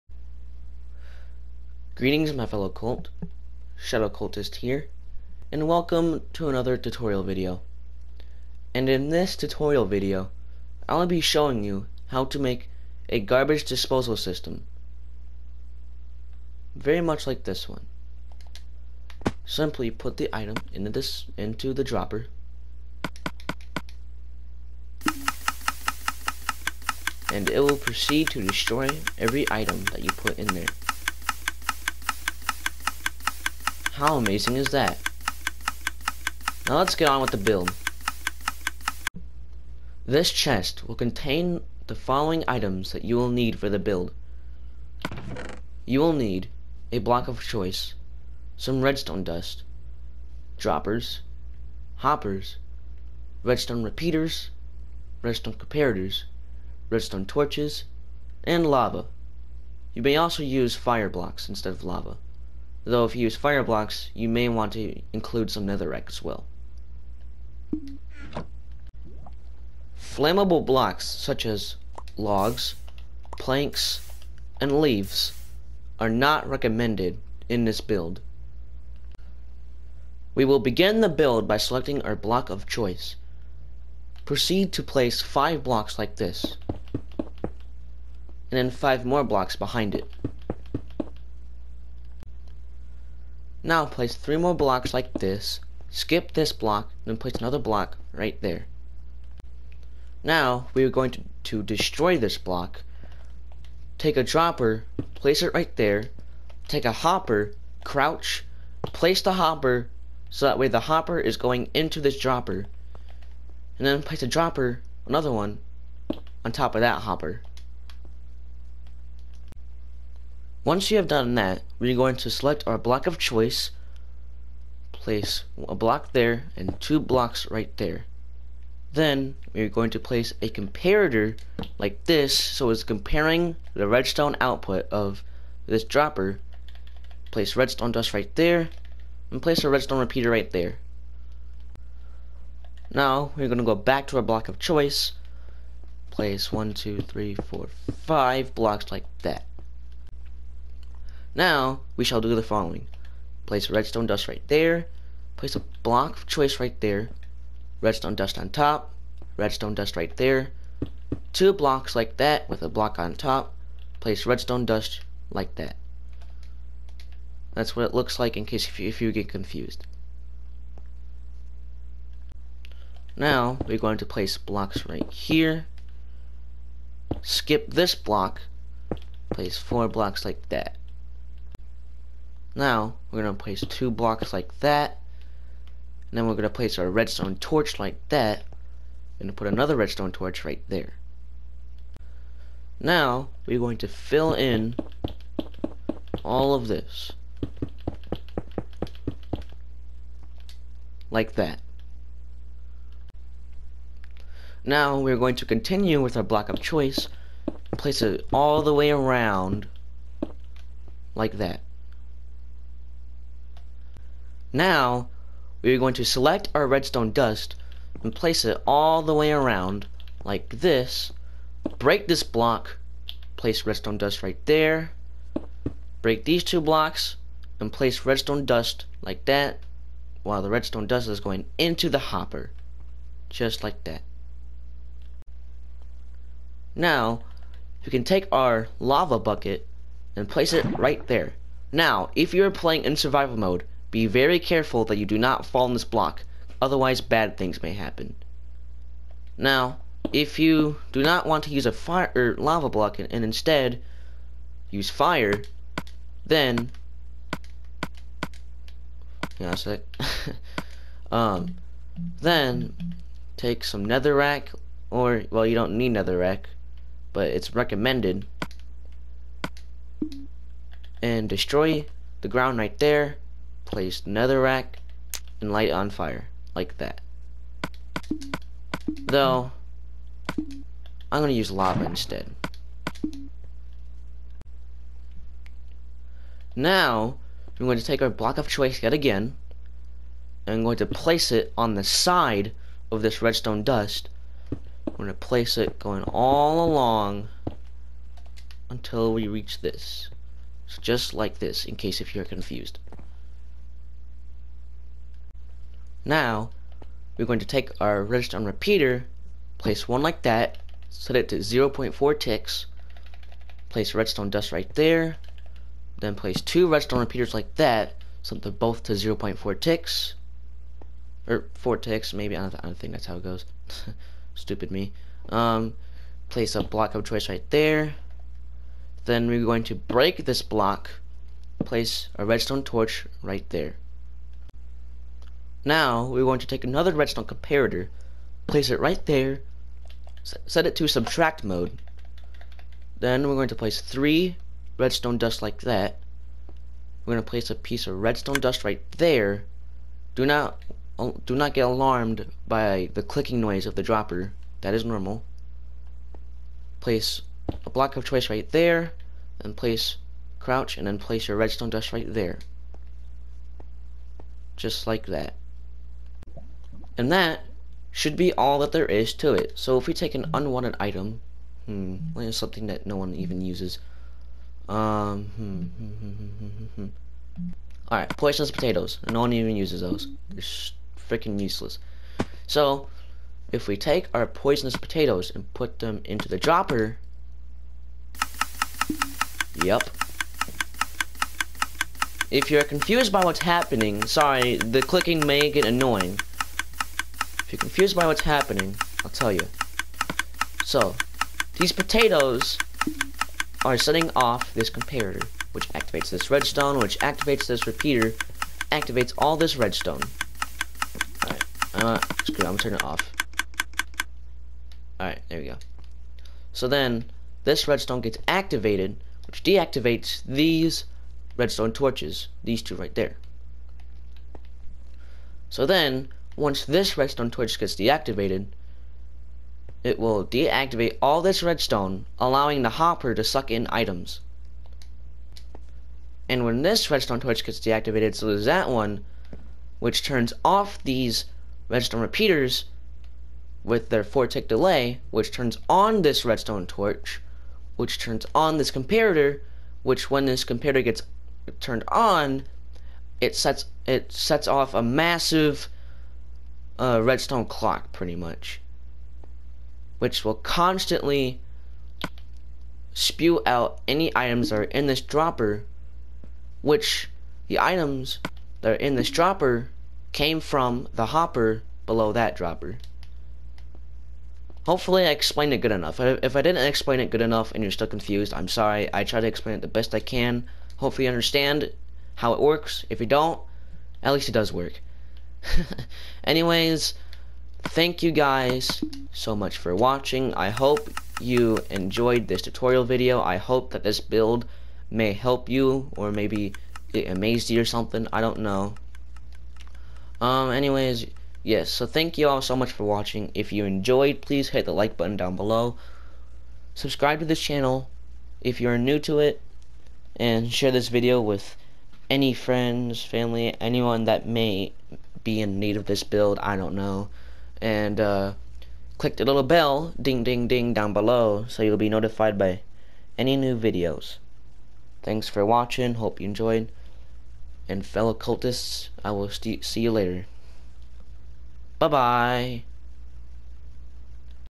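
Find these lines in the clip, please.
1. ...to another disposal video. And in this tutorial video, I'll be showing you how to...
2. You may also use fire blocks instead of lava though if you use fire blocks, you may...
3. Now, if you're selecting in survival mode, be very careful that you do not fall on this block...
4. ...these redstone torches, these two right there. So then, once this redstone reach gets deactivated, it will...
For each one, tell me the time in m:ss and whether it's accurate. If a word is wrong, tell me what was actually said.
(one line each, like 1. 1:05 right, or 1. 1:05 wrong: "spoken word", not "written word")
1. 0:06 wrong: "tutorial", not "disposal"
2. 0:59 right
3. 4:01 wrong: "playing", not "selecting"
4. 7:00 wrong: "torch", not "reach".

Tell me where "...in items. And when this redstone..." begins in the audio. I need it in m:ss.
7:13.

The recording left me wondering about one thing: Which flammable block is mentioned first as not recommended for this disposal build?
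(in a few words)
Logs.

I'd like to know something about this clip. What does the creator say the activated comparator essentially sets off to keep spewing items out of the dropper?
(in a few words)
A redstone clock.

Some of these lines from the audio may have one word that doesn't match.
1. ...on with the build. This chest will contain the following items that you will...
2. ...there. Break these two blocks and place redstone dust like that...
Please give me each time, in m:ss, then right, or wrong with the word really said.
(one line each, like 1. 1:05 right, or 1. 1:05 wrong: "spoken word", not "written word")
1. 0:37 right
2. 3:44 right.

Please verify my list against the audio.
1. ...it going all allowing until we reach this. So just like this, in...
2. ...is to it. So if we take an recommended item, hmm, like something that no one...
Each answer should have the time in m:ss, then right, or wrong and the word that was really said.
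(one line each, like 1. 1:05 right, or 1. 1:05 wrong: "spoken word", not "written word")
1. 4:55 wrong: "along", not "allowing"
2. 6:08 wrong: "unwanted", not "recommended".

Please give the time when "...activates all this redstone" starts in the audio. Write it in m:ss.
6:48.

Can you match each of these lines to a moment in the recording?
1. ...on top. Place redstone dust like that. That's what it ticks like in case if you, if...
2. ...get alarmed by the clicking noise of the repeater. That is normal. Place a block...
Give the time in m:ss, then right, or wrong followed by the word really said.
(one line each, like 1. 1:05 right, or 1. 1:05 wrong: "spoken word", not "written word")
1. 2:42 wrong: "looks", not "ticks"
2. 5:51 wrong: "dropper", not "repeater".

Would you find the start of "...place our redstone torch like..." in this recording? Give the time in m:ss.
3:06.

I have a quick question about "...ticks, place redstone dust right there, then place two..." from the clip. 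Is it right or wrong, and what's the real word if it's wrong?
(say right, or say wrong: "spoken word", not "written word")
right.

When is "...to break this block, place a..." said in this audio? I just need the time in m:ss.
5:29.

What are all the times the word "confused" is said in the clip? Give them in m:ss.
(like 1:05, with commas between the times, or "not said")
2:49, 5:02, 6:32, 6:37, 7:57.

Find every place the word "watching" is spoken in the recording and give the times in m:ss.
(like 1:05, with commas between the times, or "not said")
8:09, 8:22, 8:45.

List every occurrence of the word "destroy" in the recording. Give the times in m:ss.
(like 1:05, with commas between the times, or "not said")
0:28, 1:41, 4:31.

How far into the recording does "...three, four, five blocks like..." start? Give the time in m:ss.
2:27.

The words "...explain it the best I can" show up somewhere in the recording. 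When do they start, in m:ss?
7:59.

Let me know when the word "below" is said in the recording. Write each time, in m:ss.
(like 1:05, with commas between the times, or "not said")
7:51, 8:25, 8:40.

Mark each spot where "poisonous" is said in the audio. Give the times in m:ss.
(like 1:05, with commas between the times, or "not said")
6:18, 6:24.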